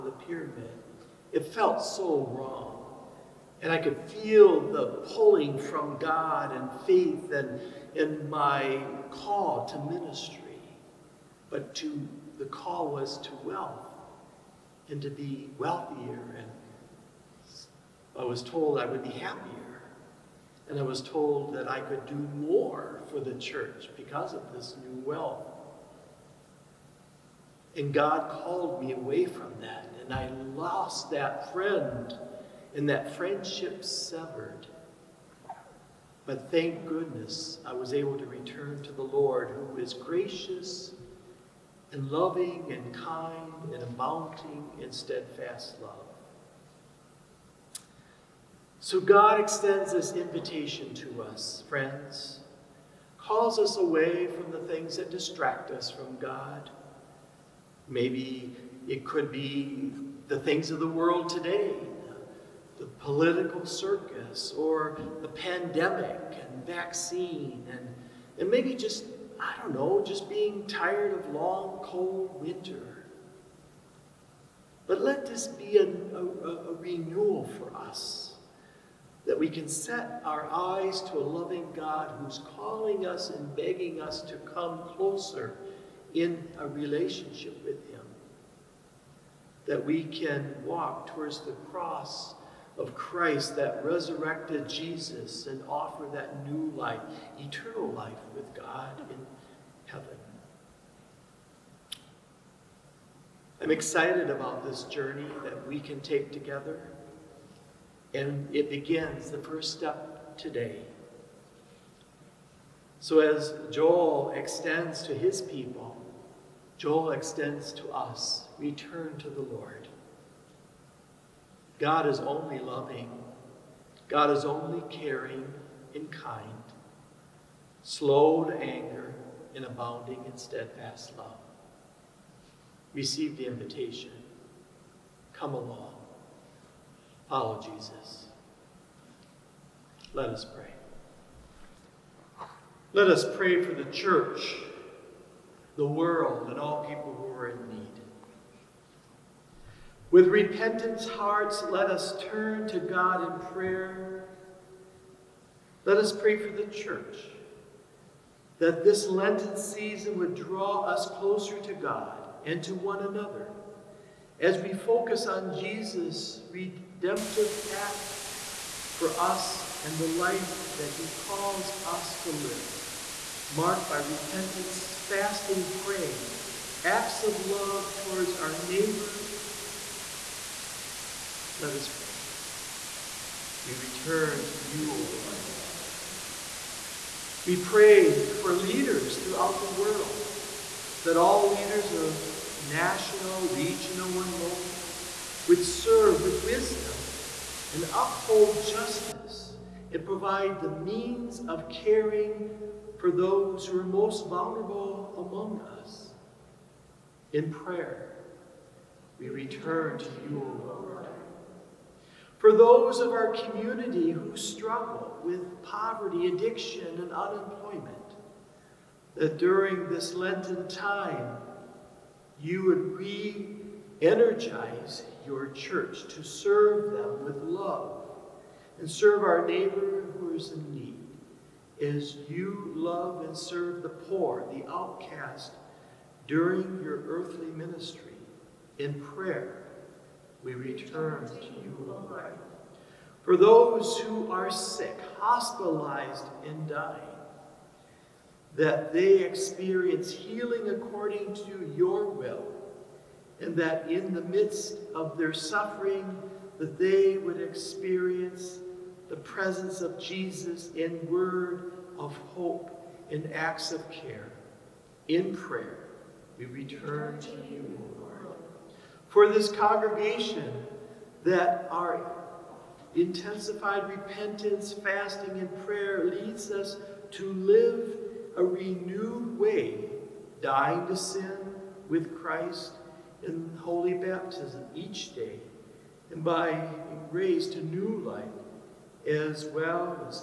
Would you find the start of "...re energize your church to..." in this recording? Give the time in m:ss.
3:42.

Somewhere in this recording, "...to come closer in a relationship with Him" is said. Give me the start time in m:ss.
1:24.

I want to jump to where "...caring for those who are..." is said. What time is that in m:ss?
3:21.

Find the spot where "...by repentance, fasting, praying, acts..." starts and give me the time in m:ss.
2:53.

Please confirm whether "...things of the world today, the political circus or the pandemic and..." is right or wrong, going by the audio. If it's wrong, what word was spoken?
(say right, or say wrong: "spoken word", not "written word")
right.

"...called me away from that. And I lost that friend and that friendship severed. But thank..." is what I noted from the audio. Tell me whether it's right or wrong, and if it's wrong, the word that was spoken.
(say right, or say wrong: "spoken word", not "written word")
right.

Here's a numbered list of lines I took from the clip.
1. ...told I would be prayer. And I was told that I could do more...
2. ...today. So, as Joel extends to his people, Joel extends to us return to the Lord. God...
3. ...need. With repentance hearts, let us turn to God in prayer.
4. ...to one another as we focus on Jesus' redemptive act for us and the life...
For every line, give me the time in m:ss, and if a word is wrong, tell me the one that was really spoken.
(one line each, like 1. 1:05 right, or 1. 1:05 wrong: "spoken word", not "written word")
1. 0:18 wrong: "happier", not "prayer"
2. 1:50 right
3. 2:27 right
4. 2:42 right.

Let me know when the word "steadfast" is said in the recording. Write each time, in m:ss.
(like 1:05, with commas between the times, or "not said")
0:44, 2:10.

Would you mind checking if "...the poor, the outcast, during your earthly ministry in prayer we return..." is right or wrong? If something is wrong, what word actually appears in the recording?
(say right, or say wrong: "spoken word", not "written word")
right.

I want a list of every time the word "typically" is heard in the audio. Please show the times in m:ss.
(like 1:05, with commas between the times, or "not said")
not said.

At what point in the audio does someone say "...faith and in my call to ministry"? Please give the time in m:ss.
0:06.